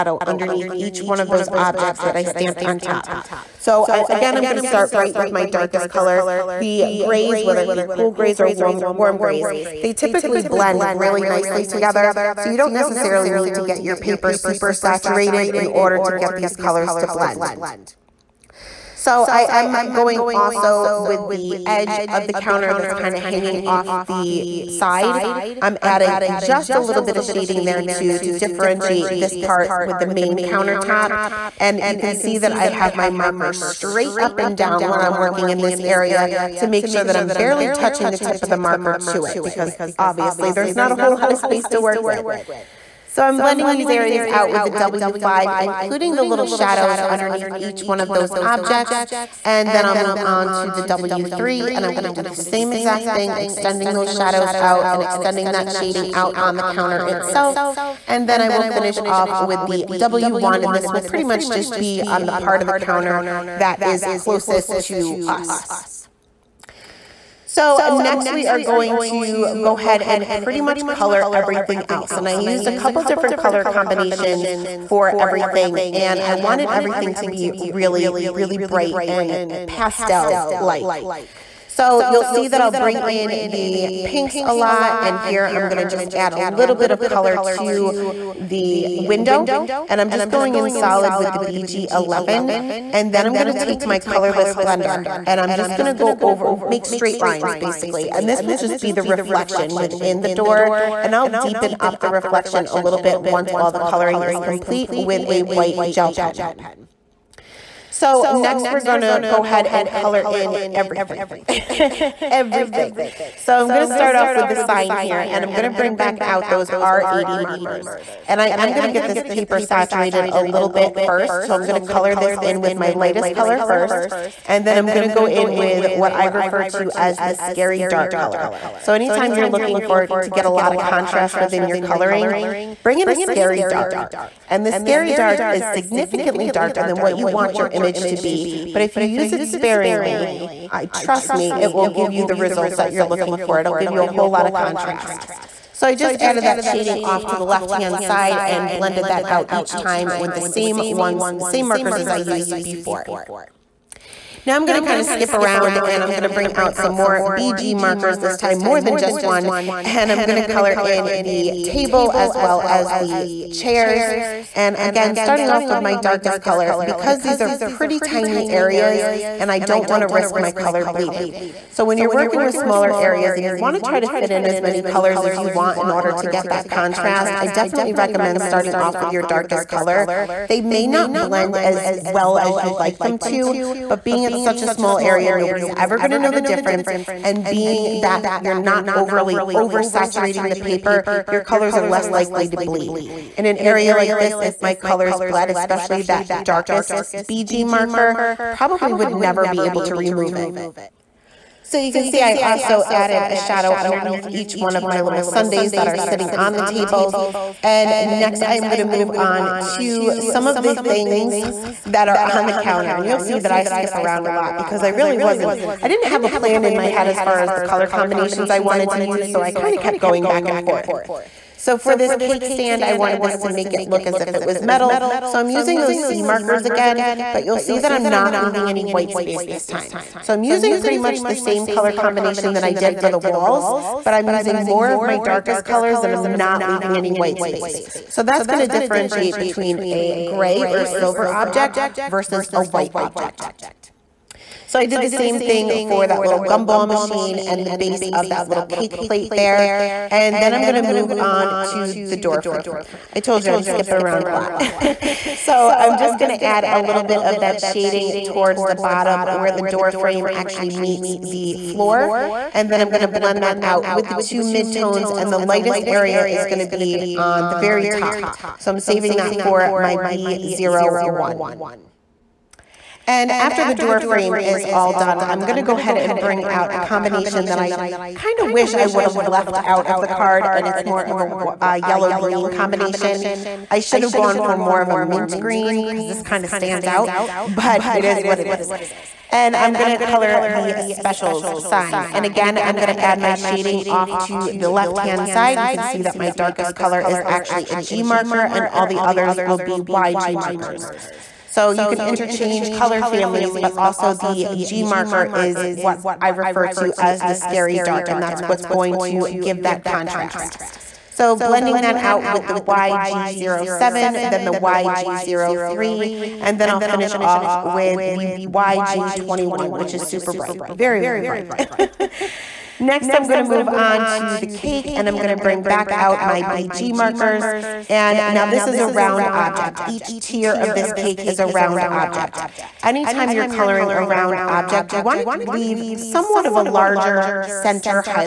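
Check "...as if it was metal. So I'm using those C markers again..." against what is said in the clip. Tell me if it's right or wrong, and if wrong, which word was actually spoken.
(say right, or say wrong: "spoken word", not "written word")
right.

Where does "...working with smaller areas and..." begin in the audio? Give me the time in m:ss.
2:52.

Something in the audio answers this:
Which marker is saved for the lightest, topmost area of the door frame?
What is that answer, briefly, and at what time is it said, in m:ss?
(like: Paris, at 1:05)
V01, at 4:29.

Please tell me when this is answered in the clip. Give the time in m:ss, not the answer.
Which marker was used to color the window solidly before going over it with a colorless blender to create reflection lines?
1:31.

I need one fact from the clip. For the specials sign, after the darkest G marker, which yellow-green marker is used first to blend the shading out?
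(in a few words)
YG07.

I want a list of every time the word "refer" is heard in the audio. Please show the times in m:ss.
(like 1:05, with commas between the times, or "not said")
2:06, 5:06.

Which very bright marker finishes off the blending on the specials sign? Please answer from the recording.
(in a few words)
YG21.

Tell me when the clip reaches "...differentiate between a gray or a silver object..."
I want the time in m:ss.
3:58.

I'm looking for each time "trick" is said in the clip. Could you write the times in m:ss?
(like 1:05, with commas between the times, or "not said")
not said.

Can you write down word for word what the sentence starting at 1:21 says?
So you'll see that I'll bring in the pinks a lot.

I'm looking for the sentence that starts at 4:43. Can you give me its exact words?
I should have gone for more of a mint green because this kind of stands out, but it is what it is.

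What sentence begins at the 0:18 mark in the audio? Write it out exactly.
So I am going also with the edge of the counter that's kind of hanging off the side.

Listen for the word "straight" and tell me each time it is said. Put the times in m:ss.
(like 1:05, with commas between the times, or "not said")
0:33, 1:36.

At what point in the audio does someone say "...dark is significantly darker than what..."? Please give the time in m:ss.
2:15.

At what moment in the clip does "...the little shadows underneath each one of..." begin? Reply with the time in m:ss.
0:46.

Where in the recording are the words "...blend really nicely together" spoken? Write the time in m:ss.
0:10.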